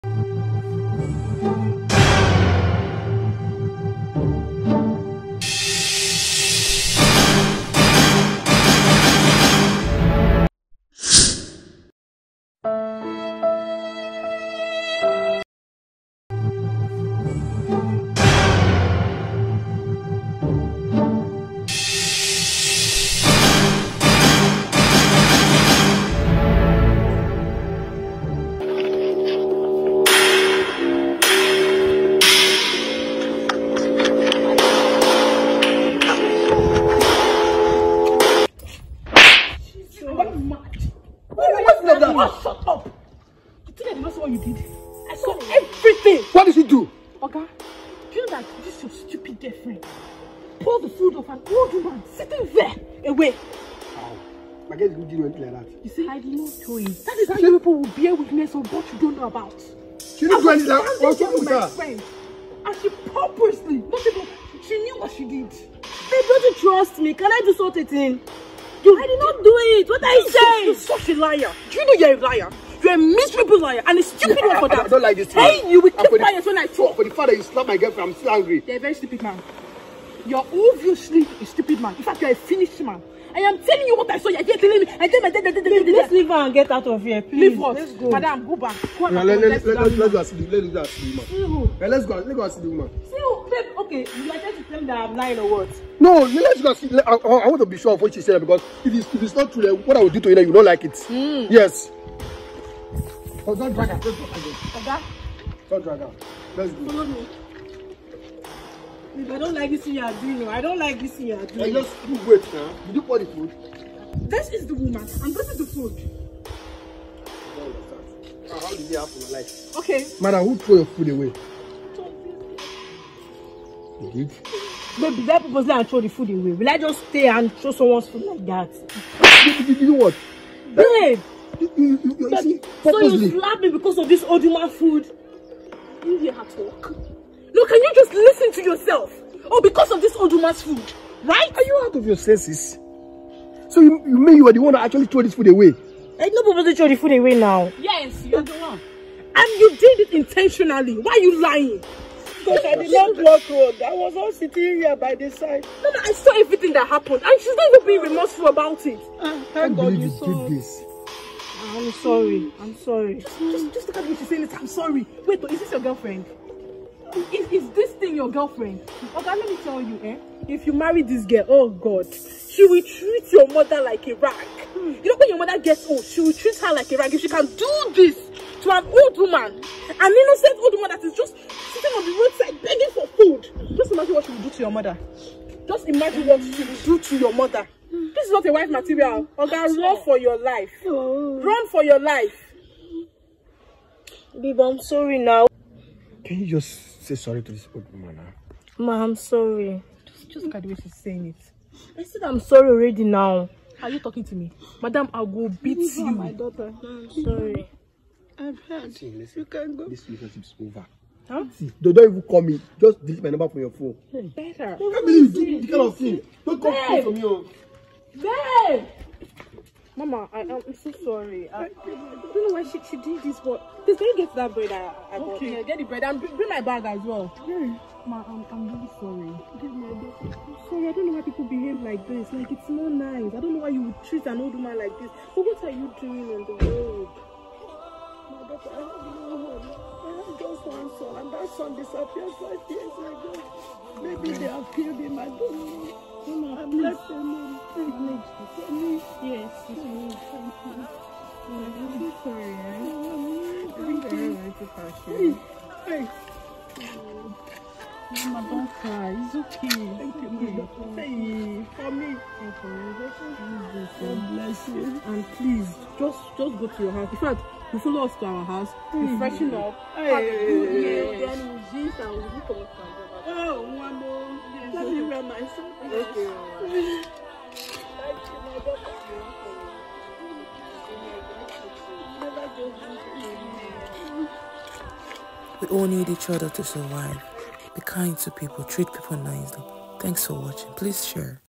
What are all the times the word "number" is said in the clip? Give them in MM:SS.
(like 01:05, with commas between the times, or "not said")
03:33.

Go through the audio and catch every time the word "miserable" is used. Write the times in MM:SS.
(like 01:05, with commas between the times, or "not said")
01:12.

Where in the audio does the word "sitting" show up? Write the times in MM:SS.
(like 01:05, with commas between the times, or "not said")
00:52, 02:34, 03:01.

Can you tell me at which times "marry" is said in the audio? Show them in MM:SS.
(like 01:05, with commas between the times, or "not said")
02:50.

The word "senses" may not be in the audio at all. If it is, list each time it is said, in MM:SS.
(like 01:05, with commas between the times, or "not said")
02:22.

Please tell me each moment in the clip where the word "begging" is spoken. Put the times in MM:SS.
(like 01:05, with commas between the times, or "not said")
03:02.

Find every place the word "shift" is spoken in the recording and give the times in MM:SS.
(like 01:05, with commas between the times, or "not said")
not said.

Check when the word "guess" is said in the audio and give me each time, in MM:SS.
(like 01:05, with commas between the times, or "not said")
00:54.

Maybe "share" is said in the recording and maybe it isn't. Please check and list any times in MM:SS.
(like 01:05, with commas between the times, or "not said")
04:51.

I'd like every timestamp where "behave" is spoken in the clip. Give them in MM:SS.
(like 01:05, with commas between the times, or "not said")
03:51.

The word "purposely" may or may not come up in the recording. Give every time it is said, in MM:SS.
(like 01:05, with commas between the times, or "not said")
01:02, 02:05.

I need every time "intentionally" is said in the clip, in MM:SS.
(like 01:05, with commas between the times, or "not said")
02:30.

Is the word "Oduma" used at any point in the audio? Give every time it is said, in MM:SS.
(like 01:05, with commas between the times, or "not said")
02:20.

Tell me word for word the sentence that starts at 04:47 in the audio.
Be kind to people, treat people nicely.